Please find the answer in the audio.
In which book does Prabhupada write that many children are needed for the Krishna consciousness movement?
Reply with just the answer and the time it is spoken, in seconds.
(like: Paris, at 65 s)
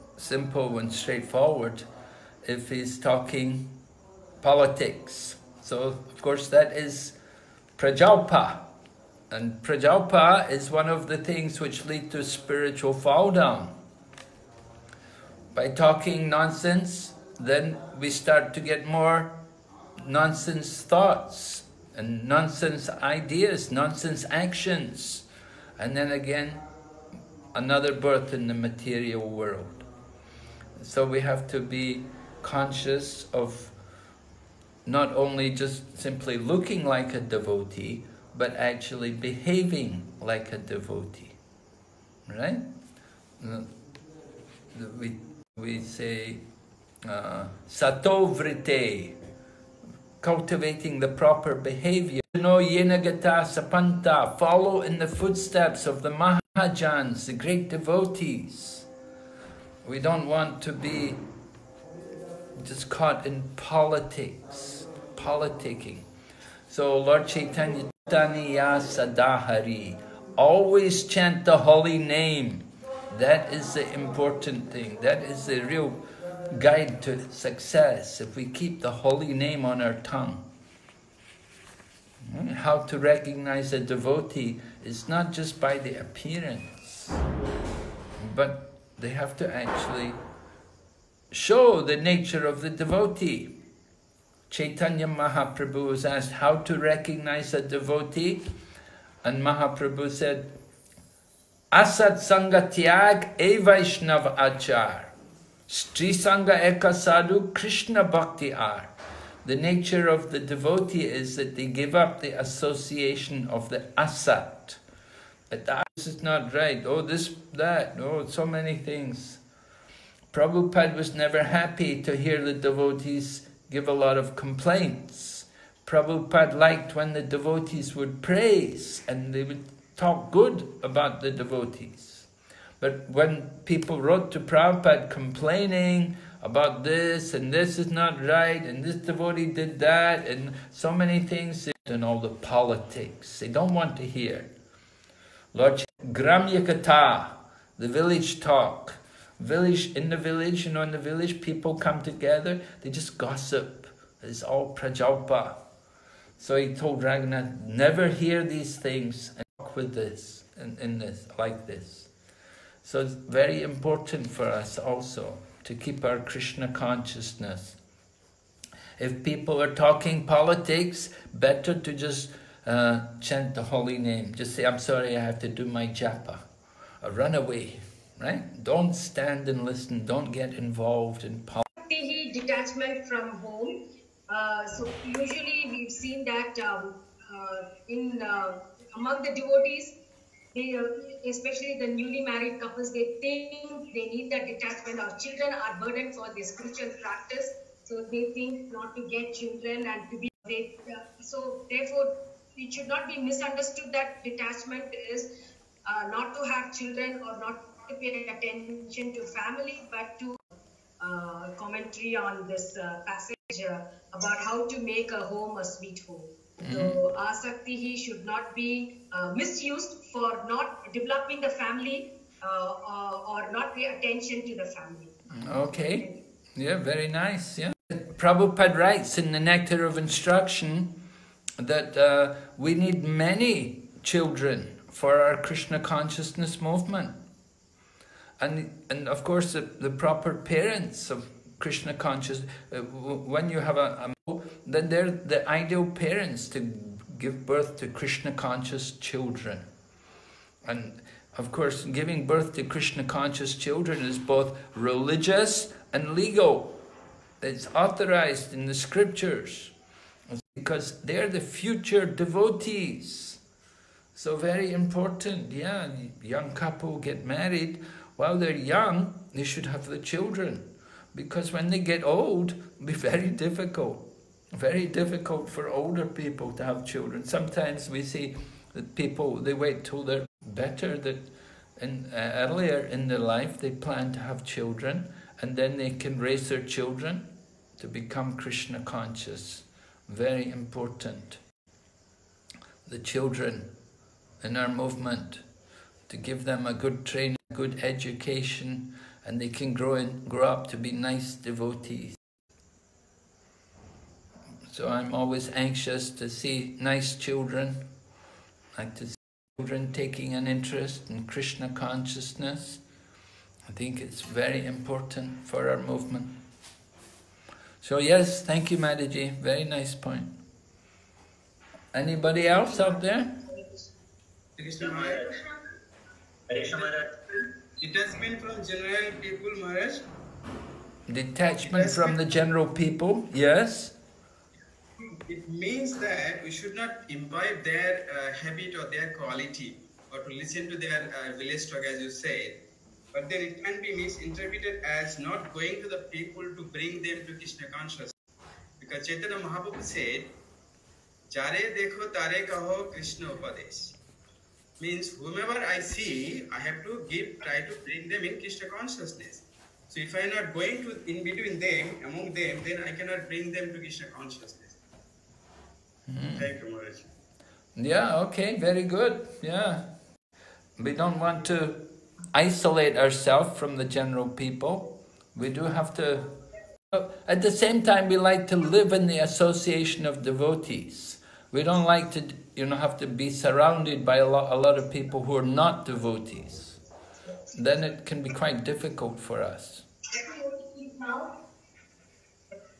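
The Nectar of Instruction, at 229 s.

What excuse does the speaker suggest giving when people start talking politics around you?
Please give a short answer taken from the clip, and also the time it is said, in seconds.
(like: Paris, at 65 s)
I have to do my japa, at 175 s.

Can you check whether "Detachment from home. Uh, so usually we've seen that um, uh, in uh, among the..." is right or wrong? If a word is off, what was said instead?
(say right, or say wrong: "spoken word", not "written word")
right.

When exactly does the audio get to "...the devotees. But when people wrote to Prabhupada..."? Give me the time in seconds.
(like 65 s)
131 s.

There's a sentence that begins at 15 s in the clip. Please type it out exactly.
By talking nonsense, then we start to get more nonsense thoughts and nonsense ideas, nonsense actions.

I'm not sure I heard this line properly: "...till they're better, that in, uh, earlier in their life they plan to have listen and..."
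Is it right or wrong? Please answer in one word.
wrong.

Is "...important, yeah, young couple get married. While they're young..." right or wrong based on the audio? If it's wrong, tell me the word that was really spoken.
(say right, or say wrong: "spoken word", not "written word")
right.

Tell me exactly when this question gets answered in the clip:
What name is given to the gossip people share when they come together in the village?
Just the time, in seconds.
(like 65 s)
146 s.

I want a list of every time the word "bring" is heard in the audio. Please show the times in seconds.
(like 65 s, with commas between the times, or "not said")
346 s, 357 s, 363 s.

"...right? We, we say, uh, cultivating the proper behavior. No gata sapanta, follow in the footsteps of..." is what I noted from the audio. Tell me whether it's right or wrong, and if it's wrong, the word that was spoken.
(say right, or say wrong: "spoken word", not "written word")
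right.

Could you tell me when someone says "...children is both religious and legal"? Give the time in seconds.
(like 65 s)
253 s.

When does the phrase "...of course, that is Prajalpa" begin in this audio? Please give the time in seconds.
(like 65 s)
5 s.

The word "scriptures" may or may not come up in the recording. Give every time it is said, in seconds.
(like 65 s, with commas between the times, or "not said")
258 s.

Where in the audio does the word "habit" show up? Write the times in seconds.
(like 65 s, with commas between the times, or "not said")
338 s.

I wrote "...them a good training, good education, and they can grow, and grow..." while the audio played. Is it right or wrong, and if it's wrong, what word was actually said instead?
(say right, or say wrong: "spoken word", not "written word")
right.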